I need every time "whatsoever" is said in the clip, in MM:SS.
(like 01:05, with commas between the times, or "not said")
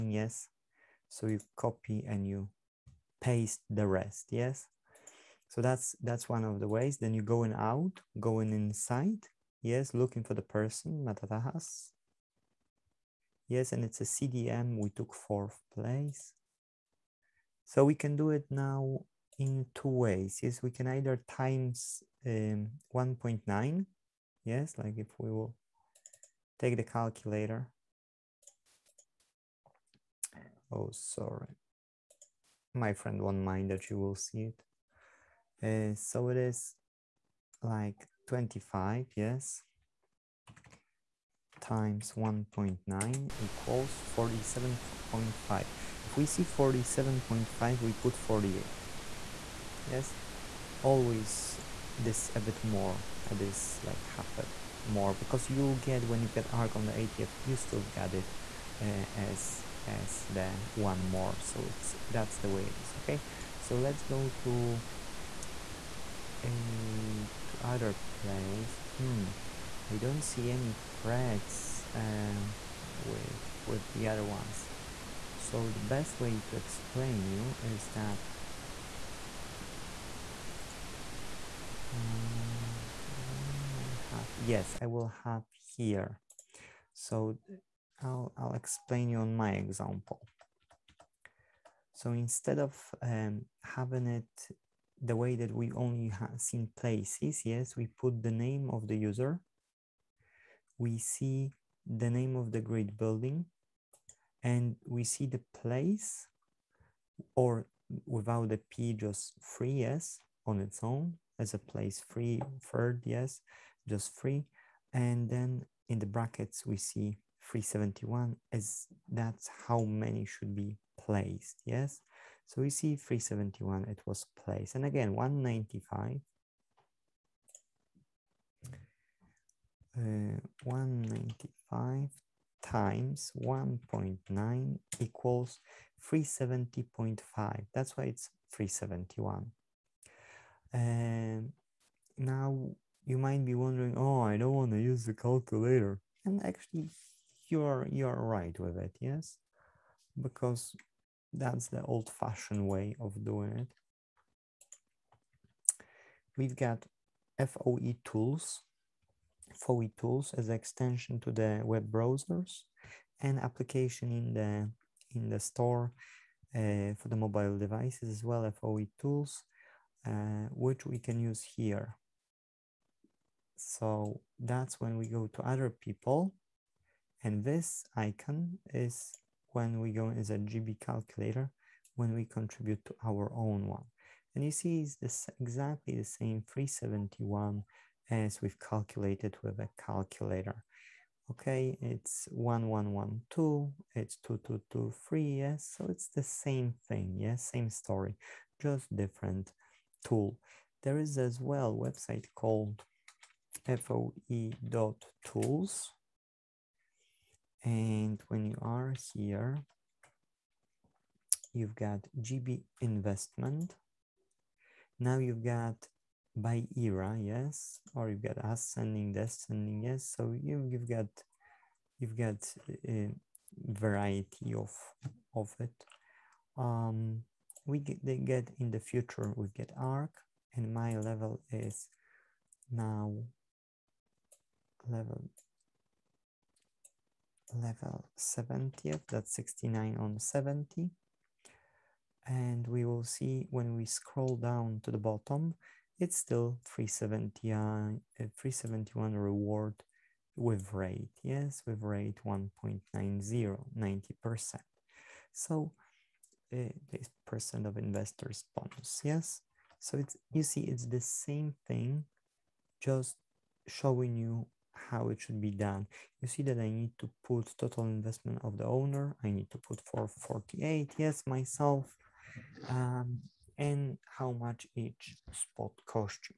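not said.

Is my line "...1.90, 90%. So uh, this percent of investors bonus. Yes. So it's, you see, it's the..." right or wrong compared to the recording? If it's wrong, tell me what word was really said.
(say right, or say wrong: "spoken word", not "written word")
right.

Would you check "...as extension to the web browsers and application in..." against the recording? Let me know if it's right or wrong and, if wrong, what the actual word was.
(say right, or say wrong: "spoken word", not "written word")
right.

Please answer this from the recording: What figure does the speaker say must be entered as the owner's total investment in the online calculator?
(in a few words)
448.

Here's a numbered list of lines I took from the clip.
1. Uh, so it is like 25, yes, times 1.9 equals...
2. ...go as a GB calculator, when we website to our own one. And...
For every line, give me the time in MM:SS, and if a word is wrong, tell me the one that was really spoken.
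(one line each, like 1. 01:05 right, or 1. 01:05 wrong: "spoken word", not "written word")
1. 00:35 right
2. 02:59 wrong: "contribute", not "website".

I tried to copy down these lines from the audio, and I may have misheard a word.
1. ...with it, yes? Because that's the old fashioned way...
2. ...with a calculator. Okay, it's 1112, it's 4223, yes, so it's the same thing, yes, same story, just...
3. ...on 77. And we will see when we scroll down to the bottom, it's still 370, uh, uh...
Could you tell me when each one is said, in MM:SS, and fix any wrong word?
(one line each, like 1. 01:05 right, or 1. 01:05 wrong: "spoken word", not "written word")
1. 02:28 right
2. 03:09 wrong: "2223", not "4223"
3. 03:59 wrong: "70", not "77".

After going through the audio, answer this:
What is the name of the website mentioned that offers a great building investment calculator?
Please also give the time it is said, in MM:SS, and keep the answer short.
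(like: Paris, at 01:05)
foe.tools, at 03:23.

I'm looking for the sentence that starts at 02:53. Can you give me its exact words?
So that's when we go to other people.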